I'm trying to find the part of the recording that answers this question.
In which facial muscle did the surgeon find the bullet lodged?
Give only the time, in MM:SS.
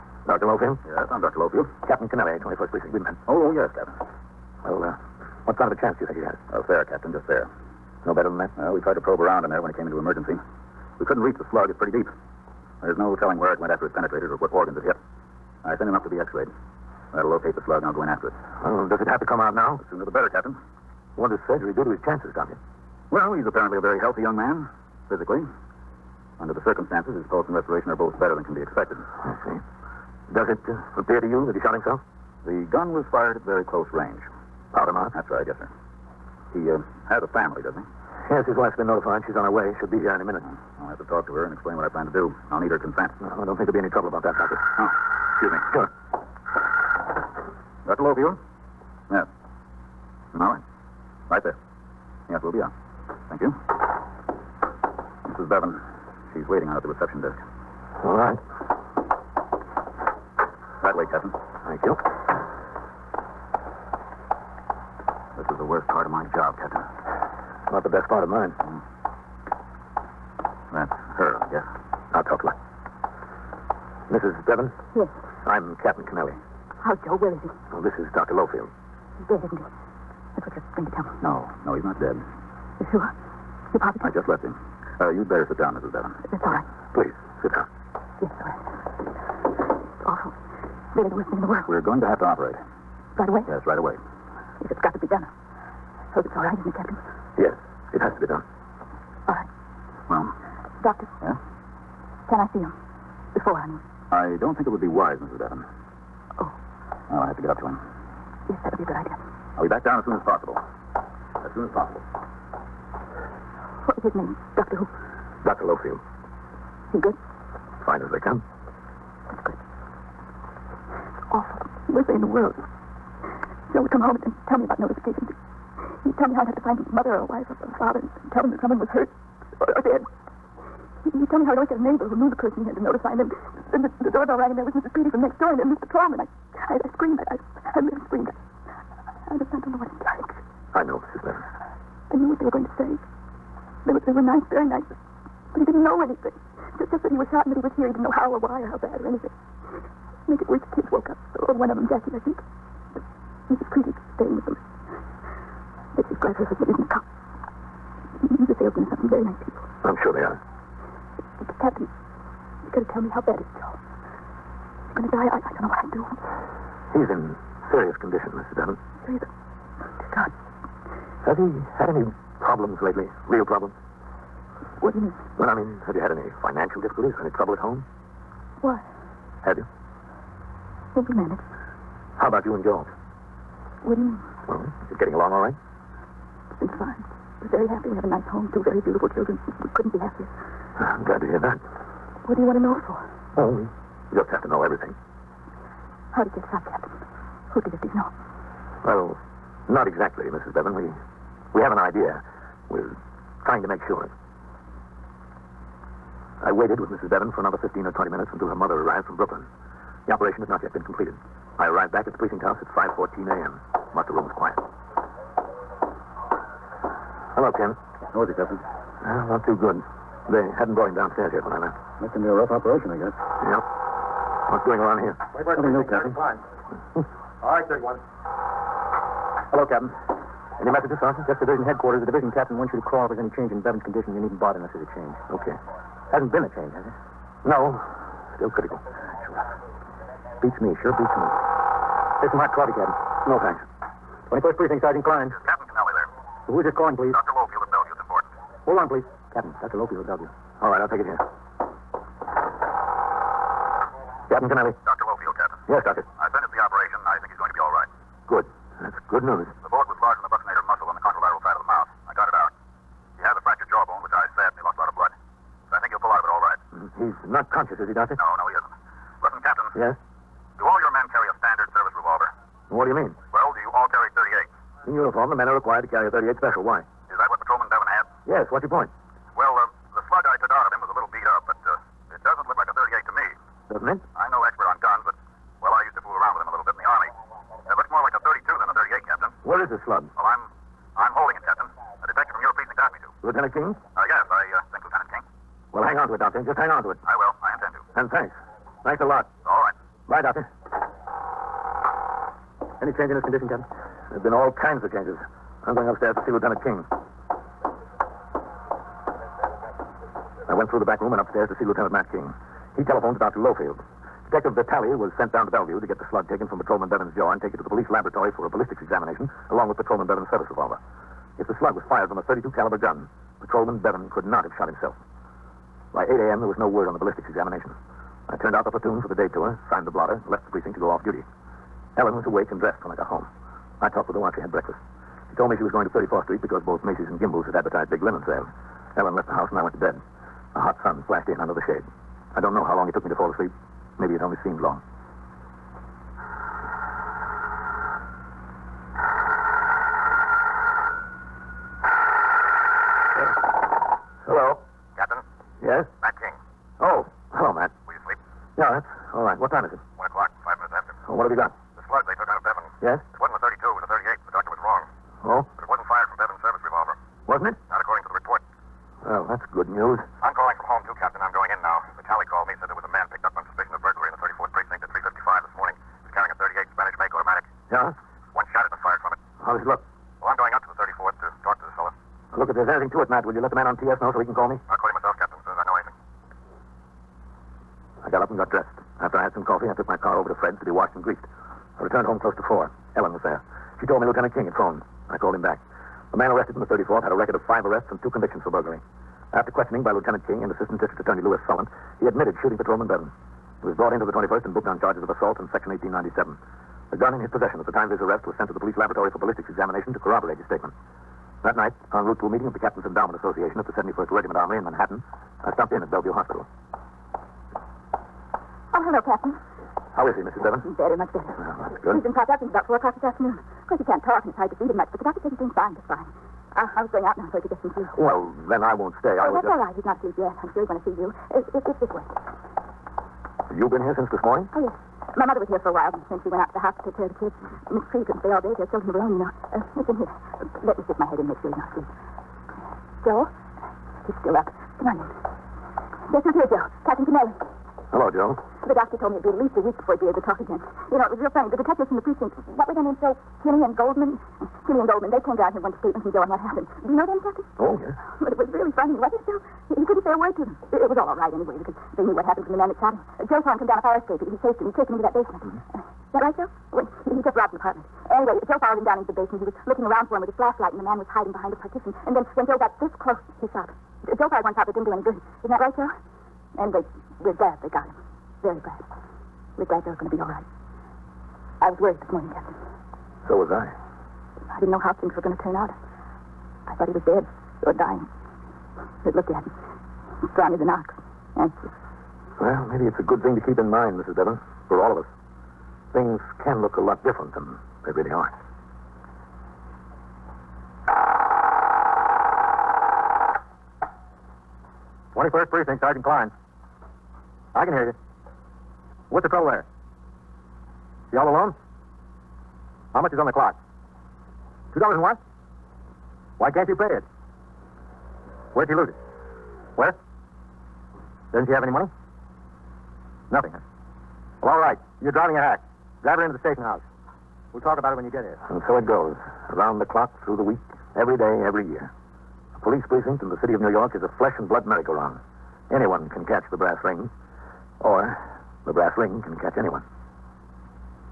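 04:20.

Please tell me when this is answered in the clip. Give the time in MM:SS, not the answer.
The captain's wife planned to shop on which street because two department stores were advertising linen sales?
05:35.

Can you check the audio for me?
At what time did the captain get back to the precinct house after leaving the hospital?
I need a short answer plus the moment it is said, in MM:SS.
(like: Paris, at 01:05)
5:14 a.m., at 03:32.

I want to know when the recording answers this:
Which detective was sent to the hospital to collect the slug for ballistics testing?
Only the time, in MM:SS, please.
05:14.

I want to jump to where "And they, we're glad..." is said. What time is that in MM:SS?
07:56.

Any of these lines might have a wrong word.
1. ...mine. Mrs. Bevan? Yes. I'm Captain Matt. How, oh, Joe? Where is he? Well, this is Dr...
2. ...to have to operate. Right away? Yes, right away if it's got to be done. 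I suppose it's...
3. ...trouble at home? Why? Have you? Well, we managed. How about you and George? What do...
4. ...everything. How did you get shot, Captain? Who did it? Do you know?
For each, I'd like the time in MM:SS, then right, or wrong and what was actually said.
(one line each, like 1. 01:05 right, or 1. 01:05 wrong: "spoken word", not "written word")
1. 01:08 wrong: "Kennelly", not "Matt"
2. 01:32 right
3. 02:57 right
4. 03:14 right.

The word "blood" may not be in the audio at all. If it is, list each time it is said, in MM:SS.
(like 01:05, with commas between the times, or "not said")
04:24, 08:54.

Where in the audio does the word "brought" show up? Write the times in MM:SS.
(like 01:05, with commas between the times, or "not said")
03:40, 06:43.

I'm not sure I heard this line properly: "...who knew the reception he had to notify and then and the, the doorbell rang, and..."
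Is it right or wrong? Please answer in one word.
wrong.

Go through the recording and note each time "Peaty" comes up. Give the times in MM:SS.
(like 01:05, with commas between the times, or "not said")
02:14.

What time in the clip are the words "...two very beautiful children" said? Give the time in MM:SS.
03:08.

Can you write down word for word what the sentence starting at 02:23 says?
They were, they were nice, very nice, but he didn't know anything.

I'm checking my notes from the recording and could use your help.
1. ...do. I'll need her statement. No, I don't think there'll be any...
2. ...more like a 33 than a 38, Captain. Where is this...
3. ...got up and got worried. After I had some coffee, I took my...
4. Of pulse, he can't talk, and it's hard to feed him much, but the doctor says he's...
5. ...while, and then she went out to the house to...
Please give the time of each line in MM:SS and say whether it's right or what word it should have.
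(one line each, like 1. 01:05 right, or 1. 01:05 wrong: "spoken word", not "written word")
1. 00:42 wrong: "consent", not "statement"
2. 04:47 wrong: "32", not "33"
3. 06:28 wrong: "dressed", not "worried"
4. 07:03 wrong: "course", not "pulse"
5. 07:15 right.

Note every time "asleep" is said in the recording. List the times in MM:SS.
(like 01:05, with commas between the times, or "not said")
05:43, 07:10, 07:21.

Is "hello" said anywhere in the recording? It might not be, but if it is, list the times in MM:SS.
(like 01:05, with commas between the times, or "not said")
03:37, 03:49, 06:58, 07:27.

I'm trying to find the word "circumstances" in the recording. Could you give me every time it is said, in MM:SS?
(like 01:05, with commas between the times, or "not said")
00:26.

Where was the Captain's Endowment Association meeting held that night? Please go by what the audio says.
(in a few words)
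71st Regiment Armory.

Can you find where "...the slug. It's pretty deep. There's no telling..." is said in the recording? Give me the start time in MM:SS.
00:11.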